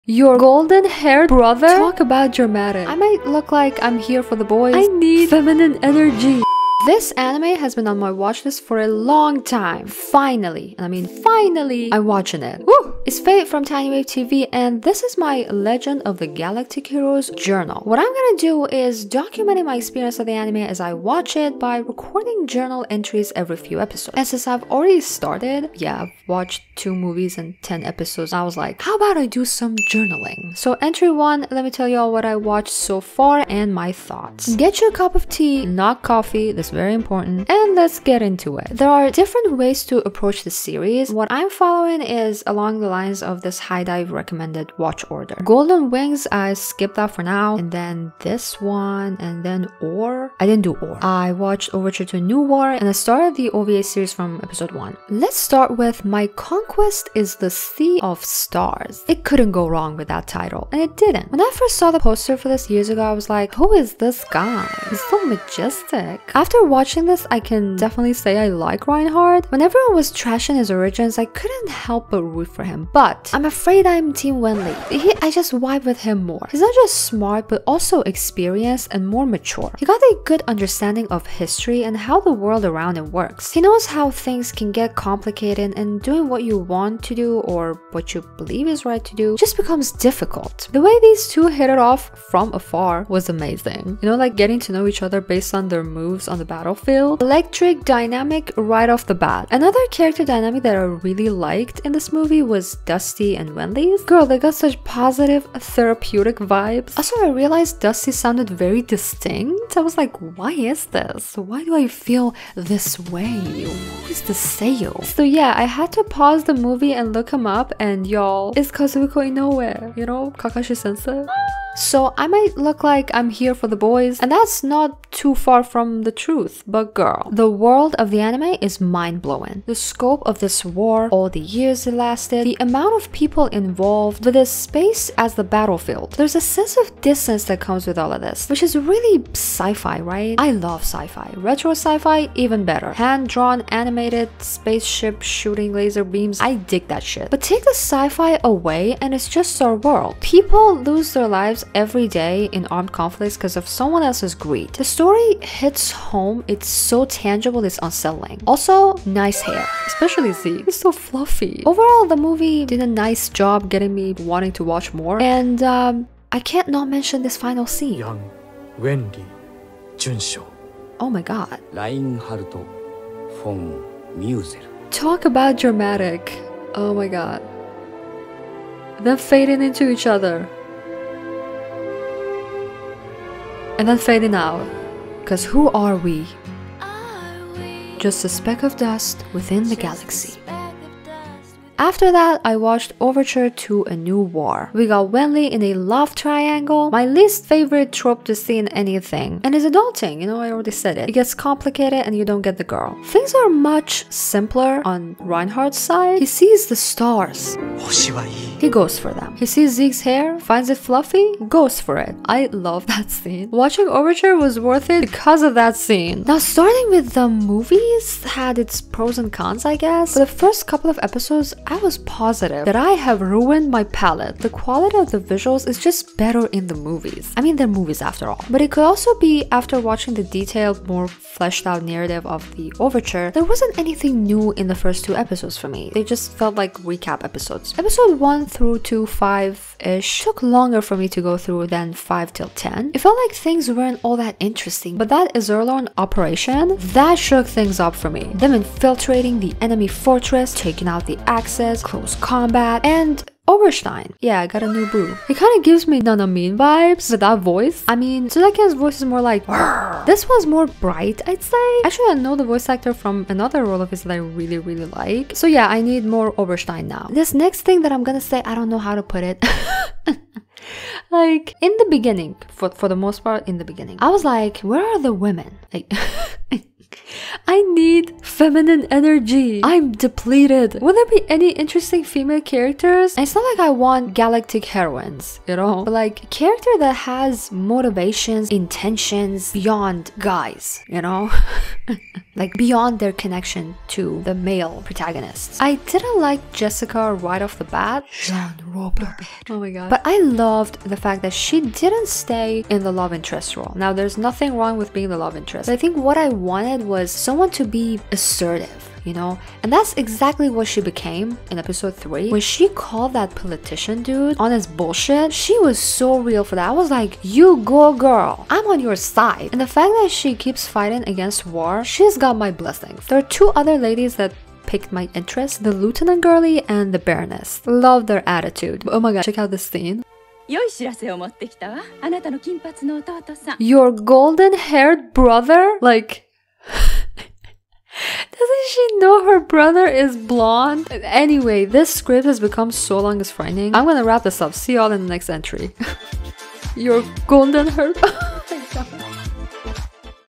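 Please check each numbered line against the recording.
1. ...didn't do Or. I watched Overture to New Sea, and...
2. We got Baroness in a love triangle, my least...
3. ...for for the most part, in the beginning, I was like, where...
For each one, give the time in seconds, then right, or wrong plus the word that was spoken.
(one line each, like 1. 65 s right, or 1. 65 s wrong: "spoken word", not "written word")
1. 50 s wrong: "War", not "Sea"
2. 194 s wrong: "Wenli", not "Baroness"
3. 272 s right.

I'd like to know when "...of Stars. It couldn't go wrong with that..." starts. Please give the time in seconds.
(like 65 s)
58 s.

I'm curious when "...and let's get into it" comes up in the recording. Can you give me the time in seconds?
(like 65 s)
37 s.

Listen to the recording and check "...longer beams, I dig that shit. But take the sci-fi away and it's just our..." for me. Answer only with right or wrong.
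wrong.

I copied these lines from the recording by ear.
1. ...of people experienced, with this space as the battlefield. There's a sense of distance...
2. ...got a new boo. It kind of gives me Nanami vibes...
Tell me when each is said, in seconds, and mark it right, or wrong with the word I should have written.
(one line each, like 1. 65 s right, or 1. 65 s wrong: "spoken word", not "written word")
1. 133 s wrong: "involved", not "experienced"
2. 254 s right.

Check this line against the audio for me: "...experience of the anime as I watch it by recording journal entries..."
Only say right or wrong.
right.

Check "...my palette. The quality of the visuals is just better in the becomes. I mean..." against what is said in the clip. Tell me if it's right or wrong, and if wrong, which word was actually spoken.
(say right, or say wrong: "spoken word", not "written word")
wrong: "movies", not "becomes".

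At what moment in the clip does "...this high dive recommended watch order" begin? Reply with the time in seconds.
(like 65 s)
43 s.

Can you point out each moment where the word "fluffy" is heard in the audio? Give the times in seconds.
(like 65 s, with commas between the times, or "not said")
160 s, 210 s.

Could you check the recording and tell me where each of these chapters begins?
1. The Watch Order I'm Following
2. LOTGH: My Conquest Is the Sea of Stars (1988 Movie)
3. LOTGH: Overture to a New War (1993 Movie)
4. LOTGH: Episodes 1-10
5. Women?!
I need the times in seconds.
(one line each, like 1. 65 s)
1. 38 s
2. 55 s
3. 191 s
4. 216 s
5. 267 s.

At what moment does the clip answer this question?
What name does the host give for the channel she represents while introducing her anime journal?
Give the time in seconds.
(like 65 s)
13 s.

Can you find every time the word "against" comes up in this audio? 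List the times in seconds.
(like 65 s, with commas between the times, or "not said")
321 s.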